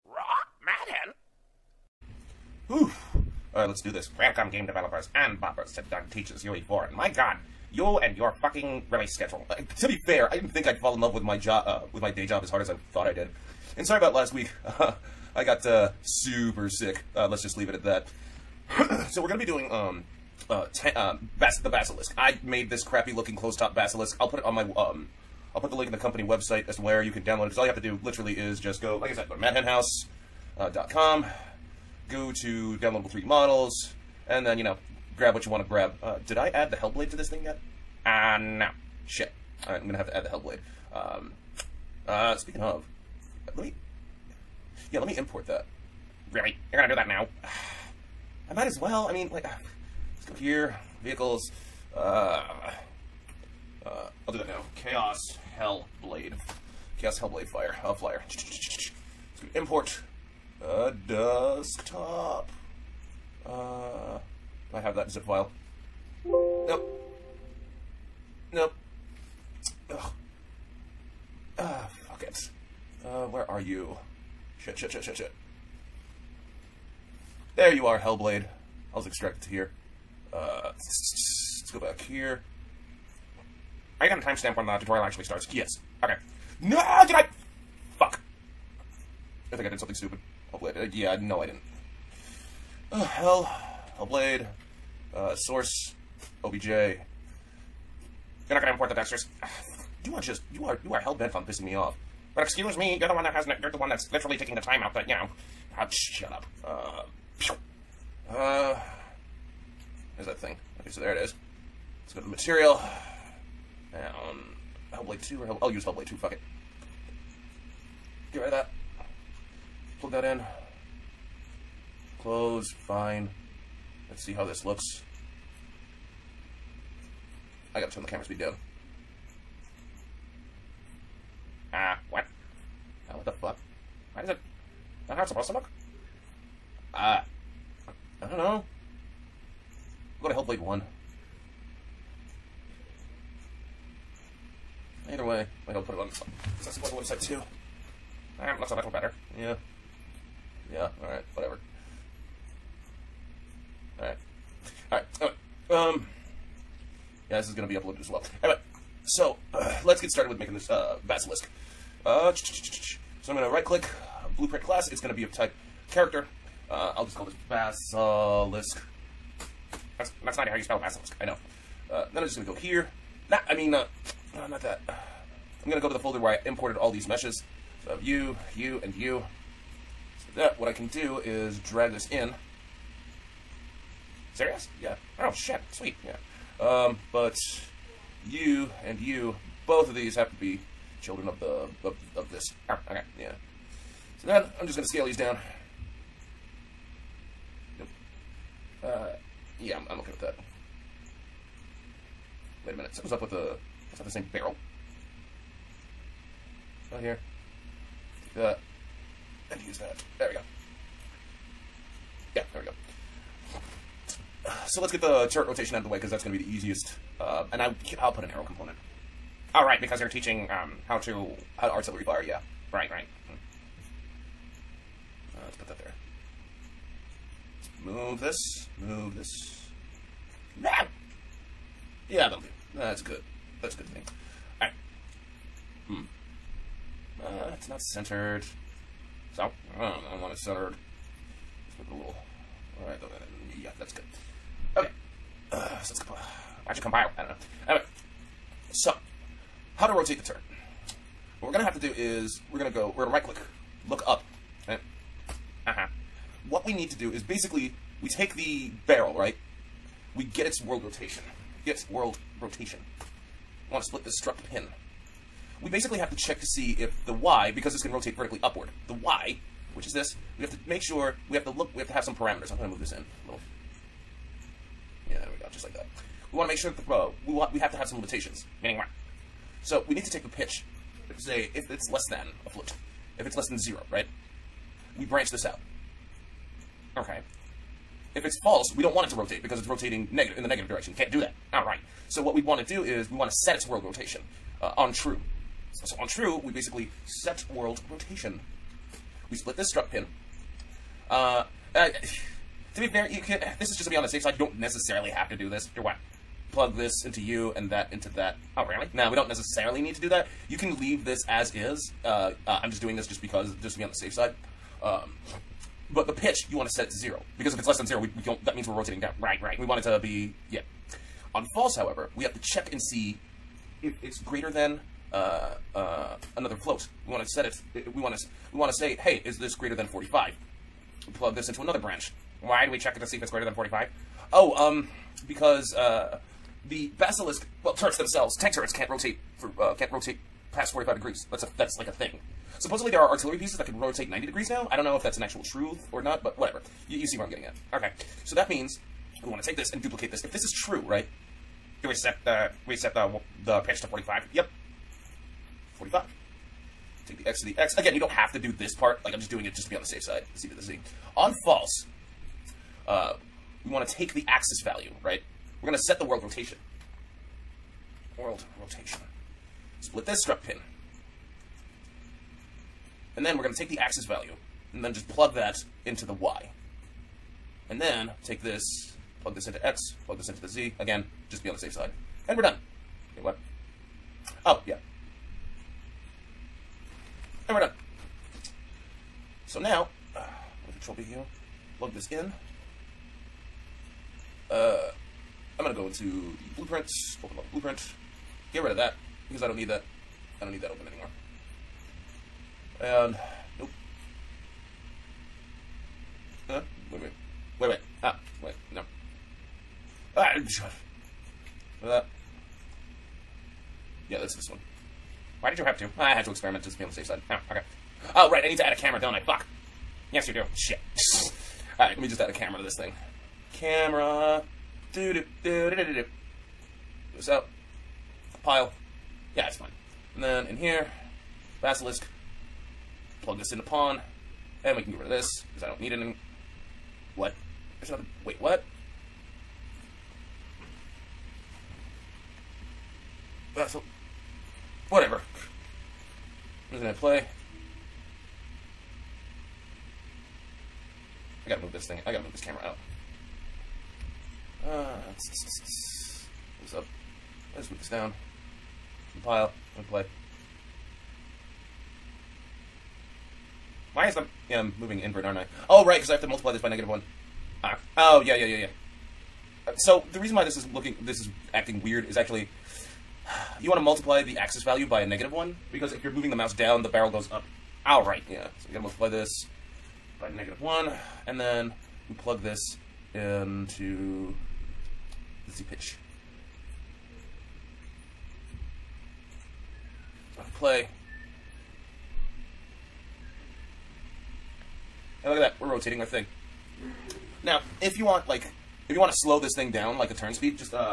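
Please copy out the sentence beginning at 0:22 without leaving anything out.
I made this crappy looking closed top basilisk.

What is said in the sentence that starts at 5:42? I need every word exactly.
Supposedly there are artillery pieces that can rotate 90 degrees now.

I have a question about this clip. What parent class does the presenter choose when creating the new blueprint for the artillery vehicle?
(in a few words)
Character.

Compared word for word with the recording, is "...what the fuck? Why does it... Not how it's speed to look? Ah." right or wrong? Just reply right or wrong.
wrong.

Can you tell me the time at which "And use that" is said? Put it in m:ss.
3:29.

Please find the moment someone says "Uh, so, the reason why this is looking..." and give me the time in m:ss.
7:49.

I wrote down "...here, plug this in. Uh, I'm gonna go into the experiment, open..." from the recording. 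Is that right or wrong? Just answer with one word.
wrong.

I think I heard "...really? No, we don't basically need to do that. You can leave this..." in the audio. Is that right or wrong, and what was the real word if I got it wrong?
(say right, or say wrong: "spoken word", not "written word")
wrong: "necessarily", not "basically".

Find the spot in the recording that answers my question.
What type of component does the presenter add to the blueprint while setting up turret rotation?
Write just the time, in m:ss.
3:38.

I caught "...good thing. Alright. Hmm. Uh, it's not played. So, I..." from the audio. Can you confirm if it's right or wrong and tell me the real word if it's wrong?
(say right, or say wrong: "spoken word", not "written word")
wrong: "centered", not "played".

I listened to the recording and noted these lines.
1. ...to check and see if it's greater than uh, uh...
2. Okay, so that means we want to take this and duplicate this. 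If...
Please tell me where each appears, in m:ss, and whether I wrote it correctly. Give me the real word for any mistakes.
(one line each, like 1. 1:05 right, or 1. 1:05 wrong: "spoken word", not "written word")
1. 5:22 right
2. 5:47 right.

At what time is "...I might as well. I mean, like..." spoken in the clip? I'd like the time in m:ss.
0:48.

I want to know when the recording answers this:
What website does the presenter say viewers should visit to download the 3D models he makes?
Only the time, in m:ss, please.
0:29.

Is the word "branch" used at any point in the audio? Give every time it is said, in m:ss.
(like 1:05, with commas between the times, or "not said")
4:45, 5:31.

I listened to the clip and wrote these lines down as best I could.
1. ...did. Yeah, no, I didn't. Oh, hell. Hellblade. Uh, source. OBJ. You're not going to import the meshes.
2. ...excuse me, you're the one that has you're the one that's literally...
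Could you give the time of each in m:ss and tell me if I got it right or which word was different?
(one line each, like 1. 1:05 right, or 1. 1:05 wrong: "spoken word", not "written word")
1. 1:30 wrong: "textures", not "meshes"
2. 1:42 right.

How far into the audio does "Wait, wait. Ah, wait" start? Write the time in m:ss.
6:47.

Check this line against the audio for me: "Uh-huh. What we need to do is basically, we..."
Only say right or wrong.
right.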